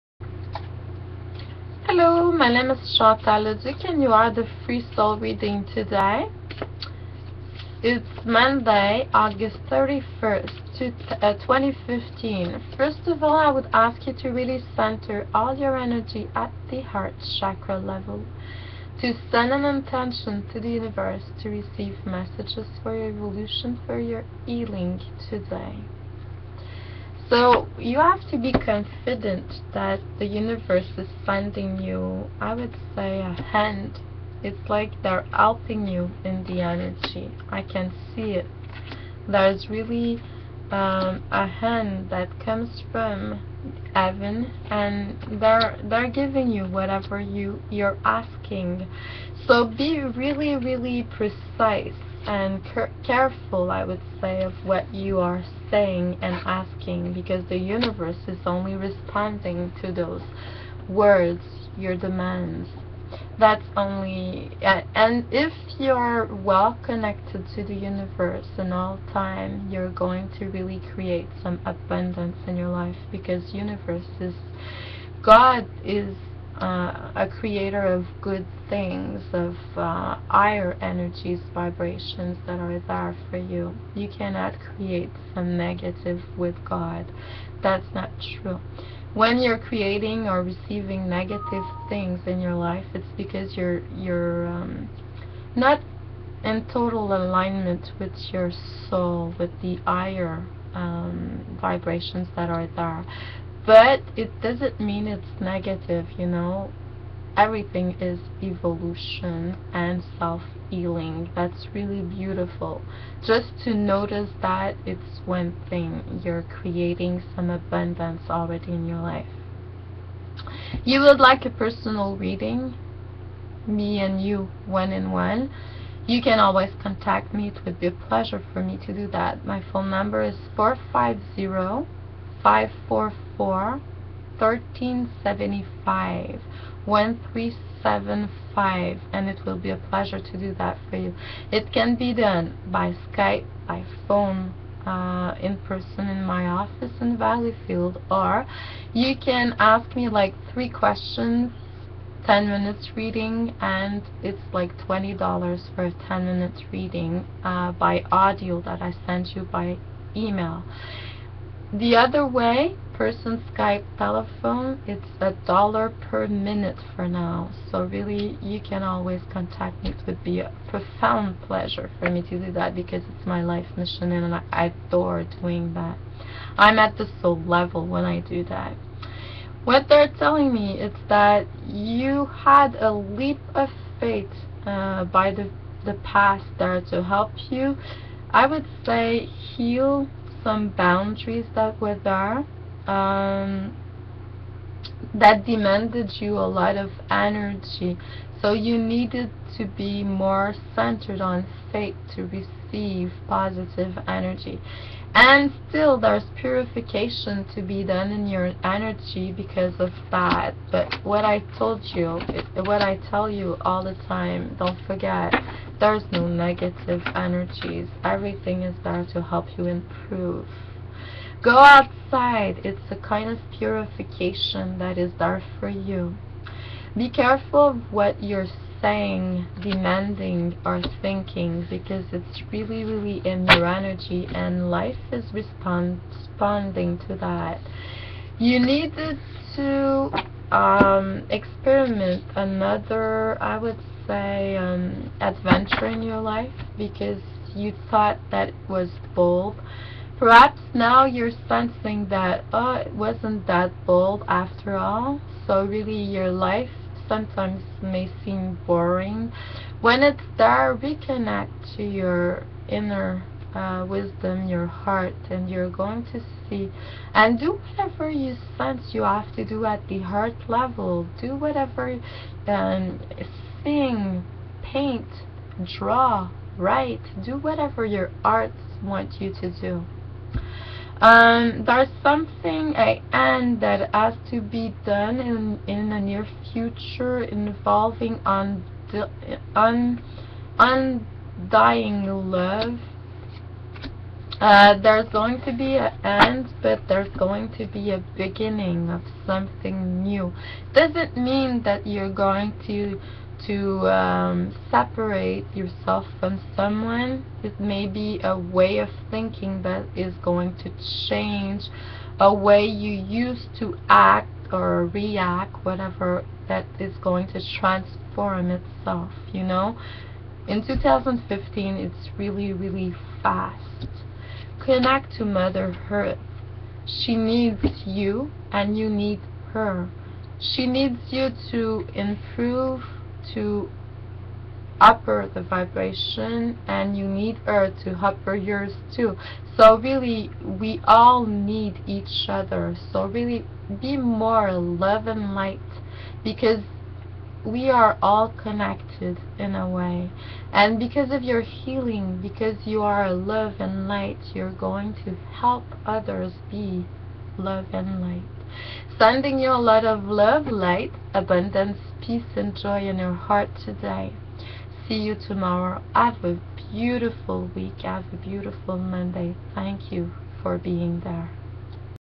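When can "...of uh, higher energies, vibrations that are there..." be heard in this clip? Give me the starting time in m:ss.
1:19.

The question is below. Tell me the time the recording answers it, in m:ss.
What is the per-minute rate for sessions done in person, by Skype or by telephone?
2:45.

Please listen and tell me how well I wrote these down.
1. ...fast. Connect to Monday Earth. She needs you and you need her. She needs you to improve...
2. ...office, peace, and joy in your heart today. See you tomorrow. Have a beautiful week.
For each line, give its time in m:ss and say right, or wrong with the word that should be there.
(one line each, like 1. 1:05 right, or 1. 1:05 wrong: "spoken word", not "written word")
1. 5:23 wrong: "Mother", not "Monday"
2. 6:01 wrong: "abundance", not "office".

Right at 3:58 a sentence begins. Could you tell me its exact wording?
You need to um, experiment another, I would say, um, adventure in your life because you thought that was bold.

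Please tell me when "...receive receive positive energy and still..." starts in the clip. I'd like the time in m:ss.
3:22.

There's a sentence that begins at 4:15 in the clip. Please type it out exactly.
So really your life sometimes may seem boring.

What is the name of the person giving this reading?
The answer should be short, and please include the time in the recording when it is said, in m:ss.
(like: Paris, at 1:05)
Chantal Leduc, at 0:02.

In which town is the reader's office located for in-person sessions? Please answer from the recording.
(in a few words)
Valleyfield.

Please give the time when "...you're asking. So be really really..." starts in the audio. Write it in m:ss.
0:47.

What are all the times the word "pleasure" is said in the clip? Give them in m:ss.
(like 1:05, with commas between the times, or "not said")
2:07, 2:19, 2:51.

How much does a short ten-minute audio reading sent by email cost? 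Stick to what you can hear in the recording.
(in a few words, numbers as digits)
$20.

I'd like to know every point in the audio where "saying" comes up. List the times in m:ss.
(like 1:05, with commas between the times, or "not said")
0:55, 3:48.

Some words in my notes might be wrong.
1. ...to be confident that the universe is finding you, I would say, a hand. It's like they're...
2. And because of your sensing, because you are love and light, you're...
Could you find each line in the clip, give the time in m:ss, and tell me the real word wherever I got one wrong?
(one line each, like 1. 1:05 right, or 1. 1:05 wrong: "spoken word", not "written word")
1. 0:28 right
2. 5:50 wrong: "healing", not "sensing".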